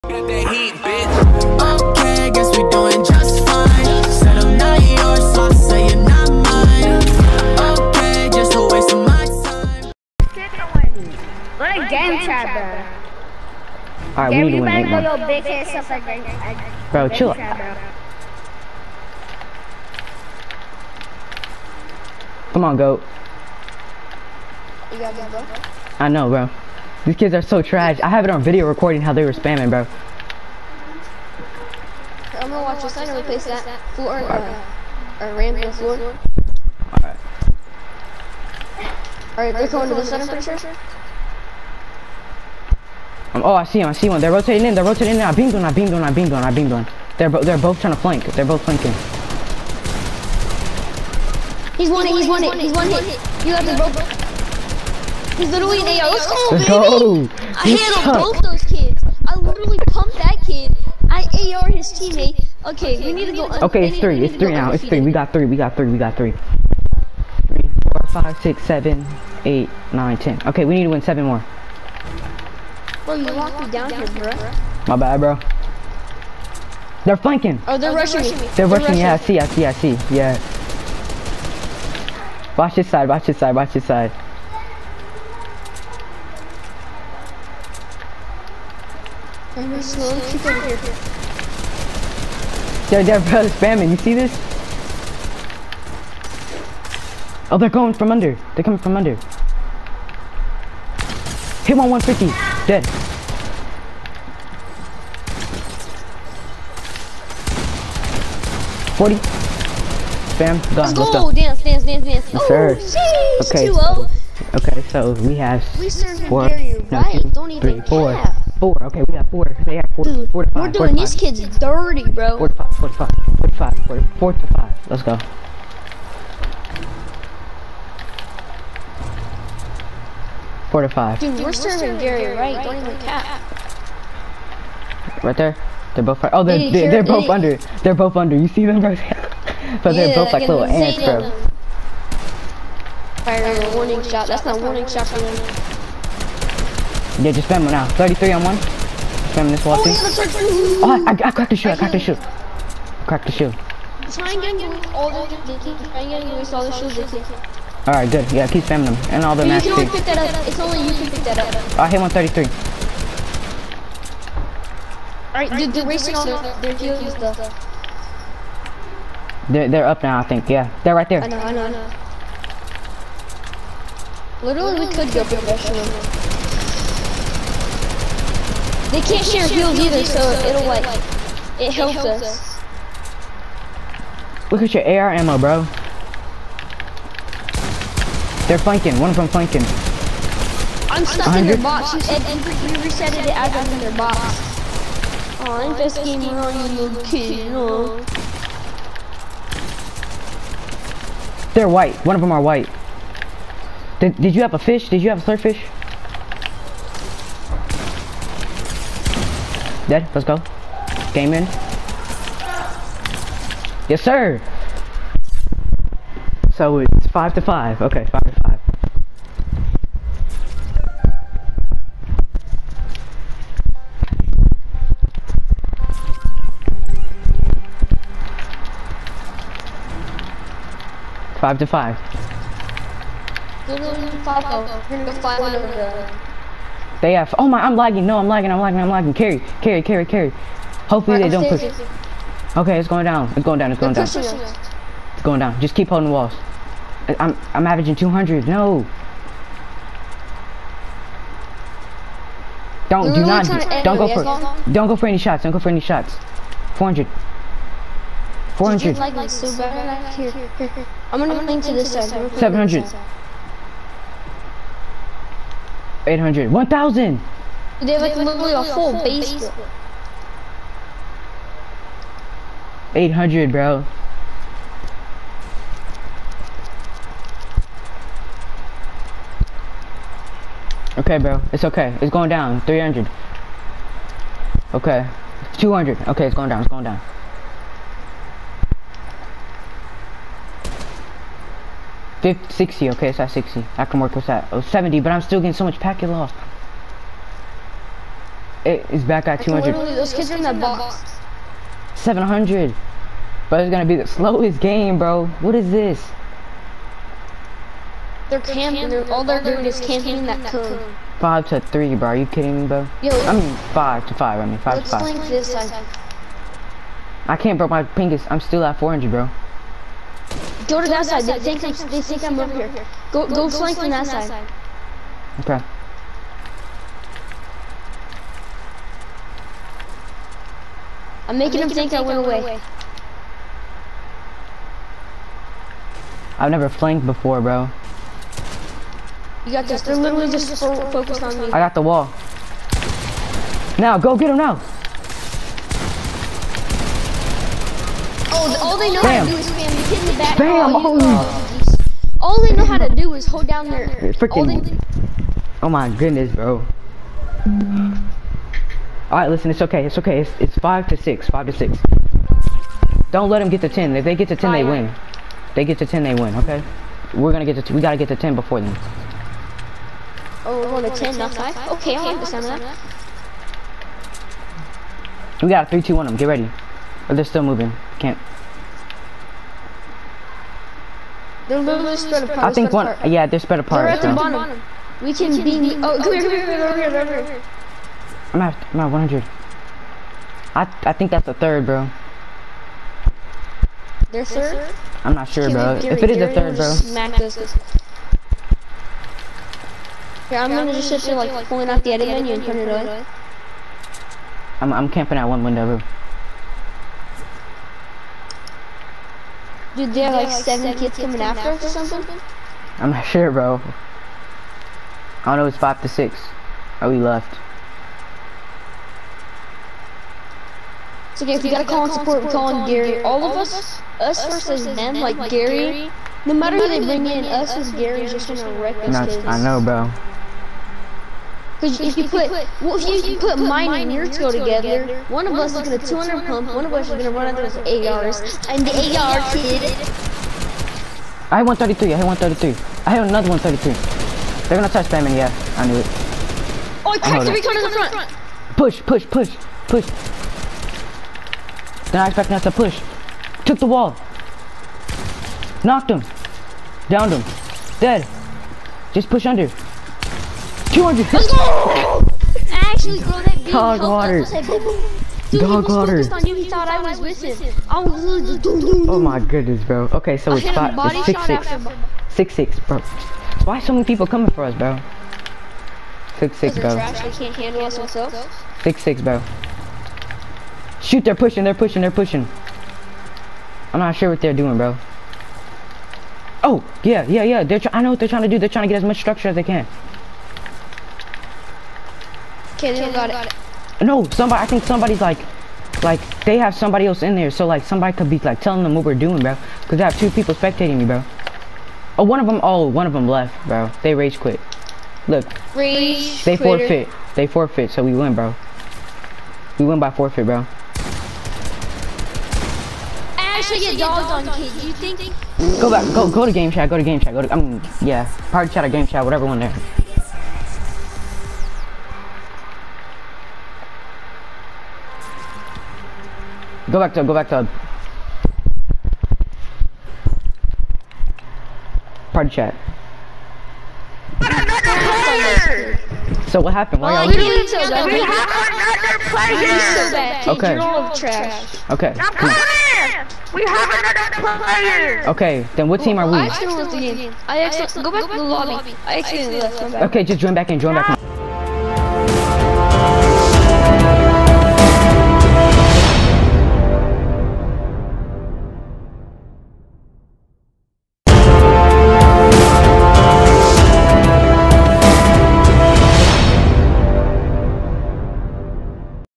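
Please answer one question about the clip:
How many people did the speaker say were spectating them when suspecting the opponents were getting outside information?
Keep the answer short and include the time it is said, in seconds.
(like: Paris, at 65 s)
2, at 499 s.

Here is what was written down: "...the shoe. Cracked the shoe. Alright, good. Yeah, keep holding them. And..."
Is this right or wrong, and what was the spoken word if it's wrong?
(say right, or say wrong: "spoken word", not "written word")
wrong: "spamming", not "holding".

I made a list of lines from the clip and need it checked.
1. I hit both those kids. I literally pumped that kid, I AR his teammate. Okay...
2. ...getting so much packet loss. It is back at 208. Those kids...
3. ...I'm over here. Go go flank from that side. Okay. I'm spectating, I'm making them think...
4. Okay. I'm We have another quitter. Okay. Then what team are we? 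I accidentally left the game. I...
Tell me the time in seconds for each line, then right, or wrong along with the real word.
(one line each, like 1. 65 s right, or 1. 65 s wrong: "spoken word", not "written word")
1. 57 s right
2. 295 s wrong: "200", not "208"
3. 322 s wrong: "making", not "spectating"
4. 541 s wrong: "player", not "quitter".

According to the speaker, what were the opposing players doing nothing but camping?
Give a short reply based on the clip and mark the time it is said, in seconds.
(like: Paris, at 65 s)
that cone, at 310 s.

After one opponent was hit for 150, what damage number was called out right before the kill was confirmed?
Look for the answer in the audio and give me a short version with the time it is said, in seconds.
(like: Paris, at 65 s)
40, at 108 s.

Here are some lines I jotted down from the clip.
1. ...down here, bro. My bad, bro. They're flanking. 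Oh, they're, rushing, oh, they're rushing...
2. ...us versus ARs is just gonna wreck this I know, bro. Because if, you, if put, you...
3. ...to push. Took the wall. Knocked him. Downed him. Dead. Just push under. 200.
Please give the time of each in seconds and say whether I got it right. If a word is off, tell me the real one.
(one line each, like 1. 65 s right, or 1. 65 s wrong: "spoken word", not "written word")
1. 73 s right
2. 427 s wrong: "Gary", not "ARs"
3. 452 s right.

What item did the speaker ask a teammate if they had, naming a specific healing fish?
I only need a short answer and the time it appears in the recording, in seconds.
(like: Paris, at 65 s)
slurpfish, at 205 s.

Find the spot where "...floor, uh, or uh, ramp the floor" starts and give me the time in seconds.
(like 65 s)
33 s.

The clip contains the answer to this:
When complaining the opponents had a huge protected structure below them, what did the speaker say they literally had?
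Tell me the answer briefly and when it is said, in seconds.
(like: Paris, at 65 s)
a whole basement, at 268 s.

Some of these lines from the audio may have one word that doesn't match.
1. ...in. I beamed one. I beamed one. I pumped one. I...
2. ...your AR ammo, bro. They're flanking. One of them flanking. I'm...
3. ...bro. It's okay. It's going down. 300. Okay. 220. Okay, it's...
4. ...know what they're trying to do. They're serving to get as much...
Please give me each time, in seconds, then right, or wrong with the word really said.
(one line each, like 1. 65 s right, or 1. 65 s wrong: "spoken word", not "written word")
1. 45 s wrong: "beamed", not "pumped"
2. 184 s right
3. 281 s wrong: "200", not "220"
4. 487 s wrong: "trying", not "serving".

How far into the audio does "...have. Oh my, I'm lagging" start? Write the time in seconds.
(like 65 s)
237 s.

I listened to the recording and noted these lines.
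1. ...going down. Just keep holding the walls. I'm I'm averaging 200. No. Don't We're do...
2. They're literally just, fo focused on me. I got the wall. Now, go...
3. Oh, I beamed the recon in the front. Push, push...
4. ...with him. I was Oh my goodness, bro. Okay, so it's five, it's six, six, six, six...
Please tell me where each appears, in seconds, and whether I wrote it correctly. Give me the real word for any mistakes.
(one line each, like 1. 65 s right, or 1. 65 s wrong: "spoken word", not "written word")
1. 245 s right
2. 339 s right
3. 446 s wrong: "cracked", not "beamed"
4. 467 s right.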